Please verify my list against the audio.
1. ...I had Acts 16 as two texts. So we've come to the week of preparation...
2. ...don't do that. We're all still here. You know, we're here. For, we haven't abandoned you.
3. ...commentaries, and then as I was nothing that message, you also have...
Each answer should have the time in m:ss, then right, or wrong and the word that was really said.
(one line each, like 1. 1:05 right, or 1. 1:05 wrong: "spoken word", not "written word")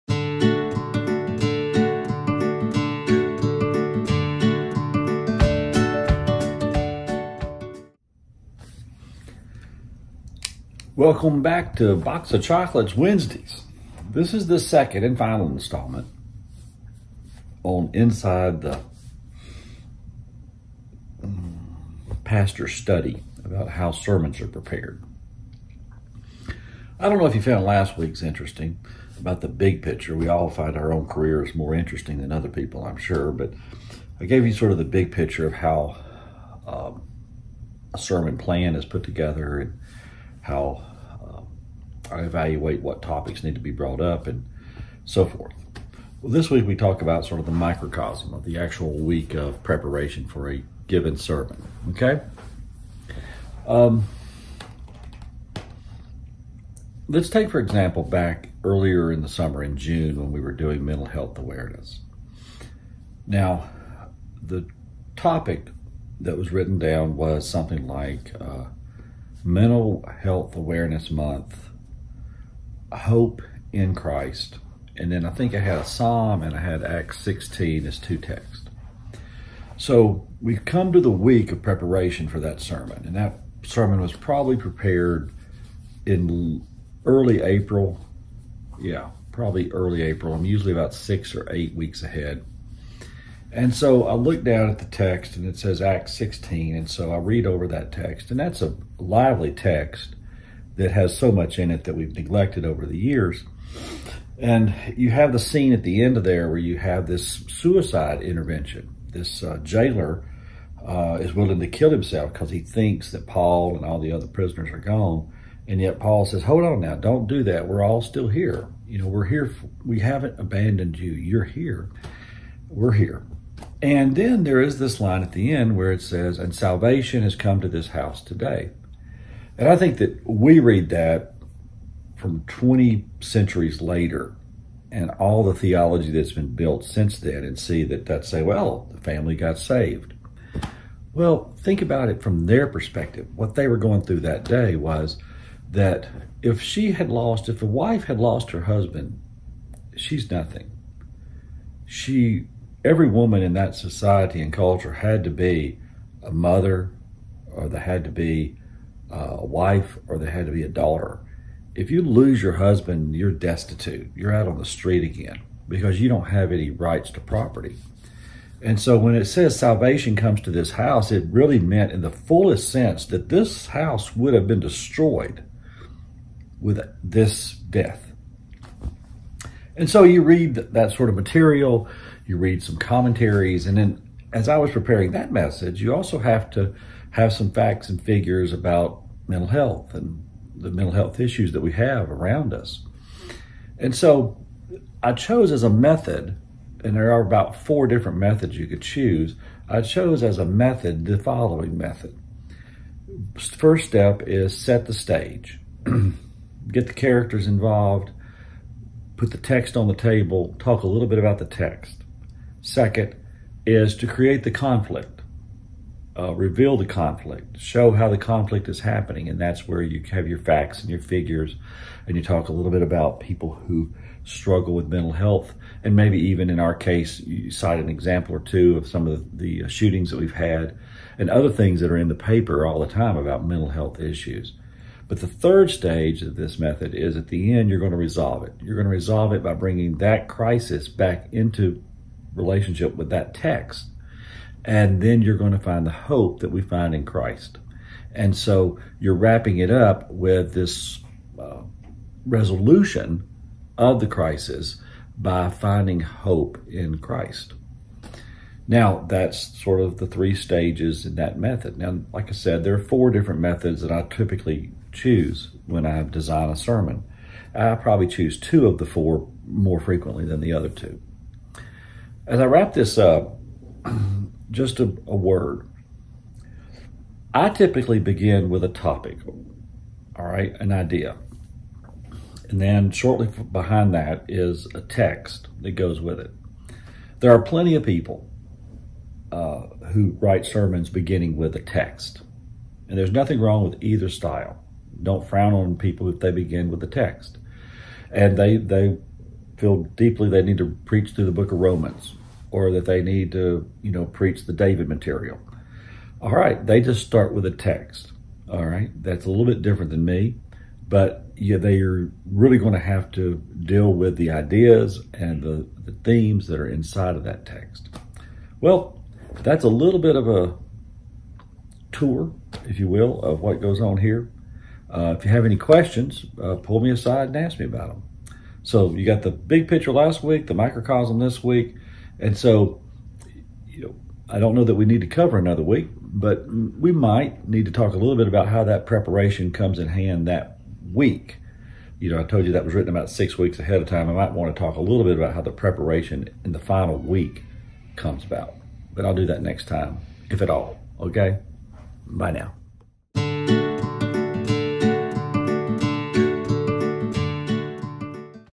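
1. 1:16 right
2. 1:56 right
3. 3:02 wrong: "preparing", not "nothing".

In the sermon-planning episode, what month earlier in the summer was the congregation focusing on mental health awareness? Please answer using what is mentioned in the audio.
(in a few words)
June.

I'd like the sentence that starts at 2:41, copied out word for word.
If you lose your husband, you're destitute.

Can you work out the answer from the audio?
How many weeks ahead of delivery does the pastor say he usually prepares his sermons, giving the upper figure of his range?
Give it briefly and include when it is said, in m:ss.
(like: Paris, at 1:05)
8, at 1:31.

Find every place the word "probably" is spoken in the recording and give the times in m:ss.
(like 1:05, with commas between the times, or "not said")
1:24, 1:29, 4:27.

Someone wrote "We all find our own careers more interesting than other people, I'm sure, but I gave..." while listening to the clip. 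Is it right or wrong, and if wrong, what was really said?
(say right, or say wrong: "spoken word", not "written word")
right.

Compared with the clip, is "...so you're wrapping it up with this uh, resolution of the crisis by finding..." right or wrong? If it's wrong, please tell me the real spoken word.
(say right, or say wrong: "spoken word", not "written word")
right.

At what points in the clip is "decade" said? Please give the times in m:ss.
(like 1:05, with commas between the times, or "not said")
not said.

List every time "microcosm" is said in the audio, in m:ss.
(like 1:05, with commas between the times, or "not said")
0:47, 5:30.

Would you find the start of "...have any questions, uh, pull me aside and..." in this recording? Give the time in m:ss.
5:25.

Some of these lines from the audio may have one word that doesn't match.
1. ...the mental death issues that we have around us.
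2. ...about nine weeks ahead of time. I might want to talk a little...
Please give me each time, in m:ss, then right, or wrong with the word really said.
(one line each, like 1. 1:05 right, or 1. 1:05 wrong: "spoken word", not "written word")
1. 3:10 wrong: "health", not "death"
2. 5:42 wrong: "six", not "nine".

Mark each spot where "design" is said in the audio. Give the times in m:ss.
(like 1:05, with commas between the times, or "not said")
4:26.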